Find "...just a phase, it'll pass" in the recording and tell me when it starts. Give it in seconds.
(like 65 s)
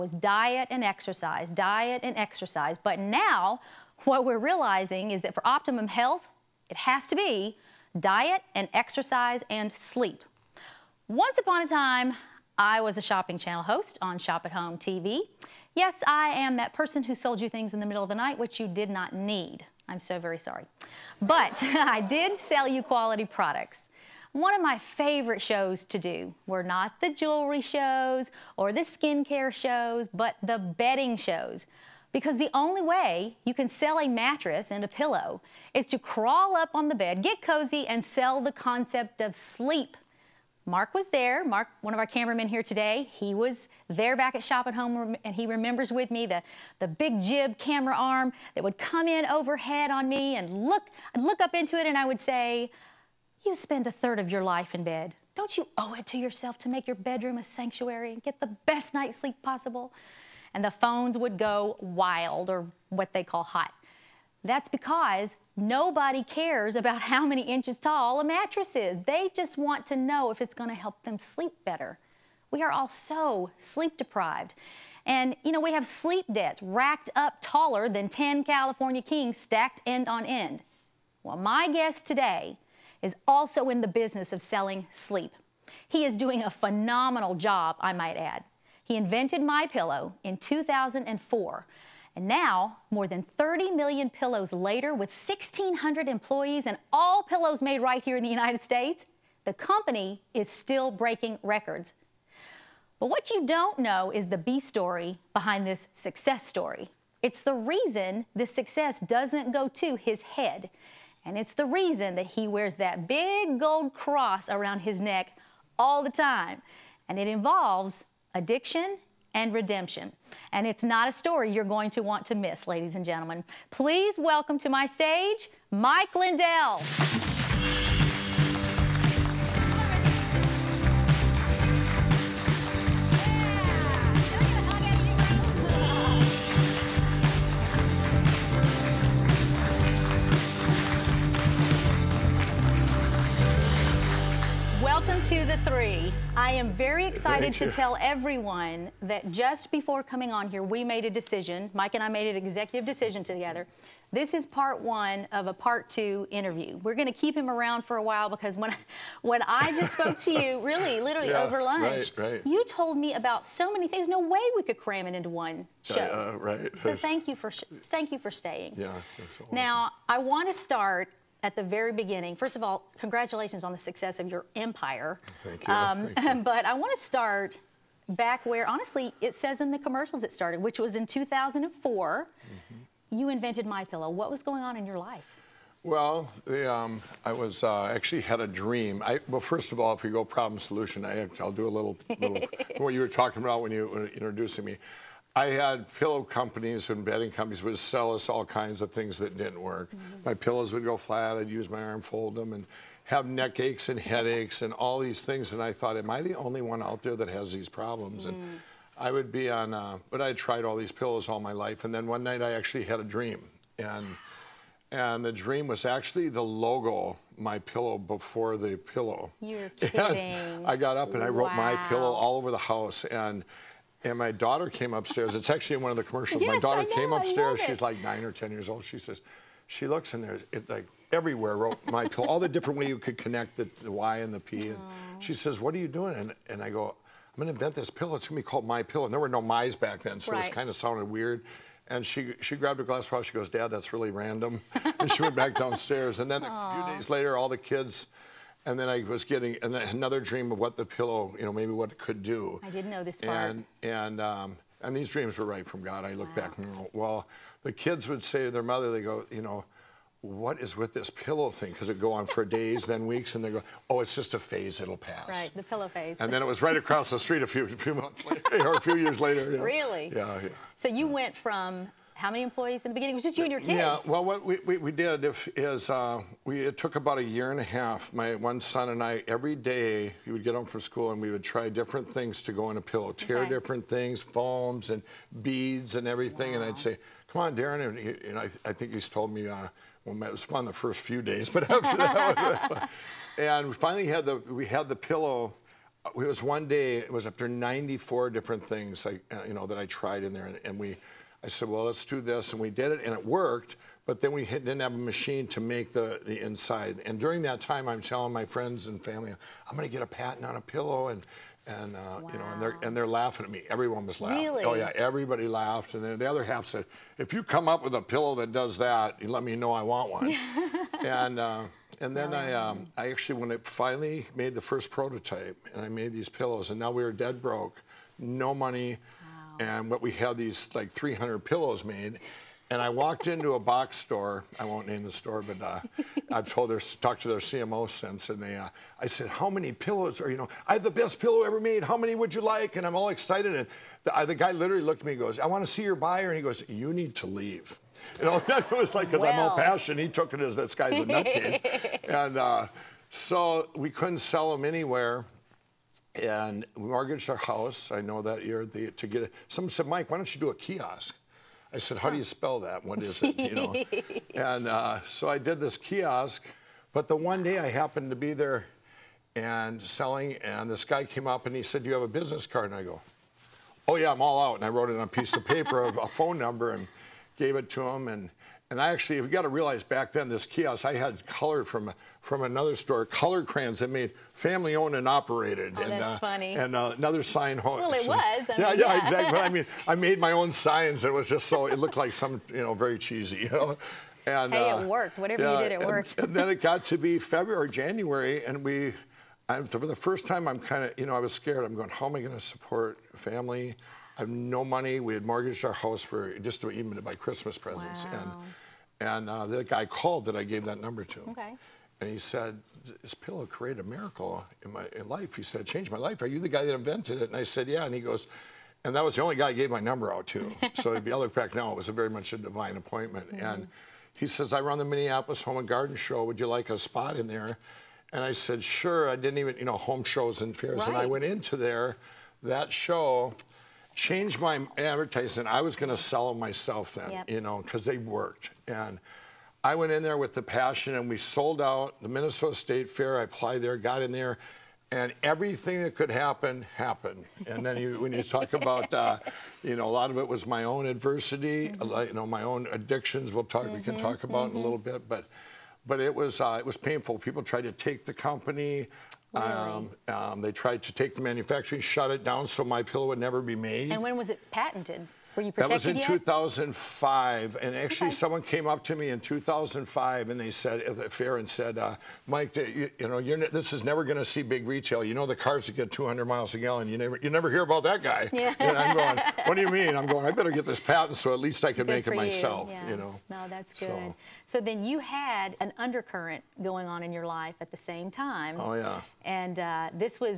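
264 s.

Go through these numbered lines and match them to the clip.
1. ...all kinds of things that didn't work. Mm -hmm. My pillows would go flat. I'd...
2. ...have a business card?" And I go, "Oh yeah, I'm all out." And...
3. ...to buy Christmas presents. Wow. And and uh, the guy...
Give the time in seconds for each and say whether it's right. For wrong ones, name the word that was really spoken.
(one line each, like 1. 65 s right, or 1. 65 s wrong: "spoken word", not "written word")
1. 198 s right
2. 371 s right
3. 406 s right.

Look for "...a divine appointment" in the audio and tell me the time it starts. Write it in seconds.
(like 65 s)
422 s.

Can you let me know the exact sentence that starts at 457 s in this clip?
People tried to take the company.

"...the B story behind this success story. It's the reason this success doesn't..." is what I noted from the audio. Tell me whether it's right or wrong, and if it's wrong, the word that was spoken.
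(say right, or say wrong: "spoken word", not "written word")
right.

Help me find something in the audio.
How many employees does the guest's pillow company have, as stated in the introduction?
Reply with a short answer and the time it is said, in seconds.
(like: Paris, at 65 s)
1,600, at 95 s.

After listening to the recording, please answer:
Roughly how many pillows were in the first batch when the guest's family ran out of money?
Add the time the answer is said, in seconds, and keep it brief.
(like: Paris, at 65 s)
300, at 330 s.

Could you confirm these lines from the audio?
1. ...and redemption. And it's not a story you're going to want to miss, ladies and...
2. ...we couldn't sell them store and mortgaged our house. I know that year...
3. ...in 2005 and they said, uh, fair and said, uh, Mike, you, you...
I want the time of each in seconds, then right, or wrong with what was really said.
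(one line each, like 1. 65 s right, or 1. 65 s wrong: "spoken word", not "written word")
1. 119 s right
2. 353 s wrong: "anywhere", not "store"
3. 469 s right.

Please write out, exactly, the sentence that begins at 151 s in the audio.
Mike and I made an executive decision together.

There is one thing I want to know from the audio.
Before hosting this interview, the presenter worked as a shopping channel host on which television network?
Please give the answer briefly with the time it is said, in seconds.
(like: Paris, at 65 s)
Shop at Home TV, at 14 s.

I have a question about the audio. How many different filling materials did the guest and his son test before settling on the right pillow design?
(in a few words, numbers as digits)
94.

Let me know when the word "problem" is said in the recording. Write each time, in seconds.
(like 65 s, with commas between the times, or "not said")
190 s, 207 s.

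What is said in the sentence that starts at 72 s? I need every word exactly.
We are all so sleep deprived.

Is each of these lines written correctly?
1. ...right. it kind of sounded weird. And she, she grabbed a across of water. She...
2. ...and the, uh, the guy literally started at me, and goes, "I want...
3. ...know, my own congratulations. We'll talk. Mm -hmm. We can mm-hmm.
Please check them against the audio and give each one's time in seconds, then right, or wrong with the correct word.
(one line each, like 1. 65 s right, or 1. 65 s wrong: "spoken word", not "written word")
1. 240 s wrong: "glass", not "across"
2. 343 s wrong: "looked", not "started"
3. 452 s wrong: "addictions", not "congratulations".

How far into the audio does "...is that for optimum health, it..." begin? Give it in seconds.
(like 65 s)
5 s.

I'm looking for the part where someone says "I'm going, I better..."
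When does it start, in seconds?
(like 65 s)
479 s.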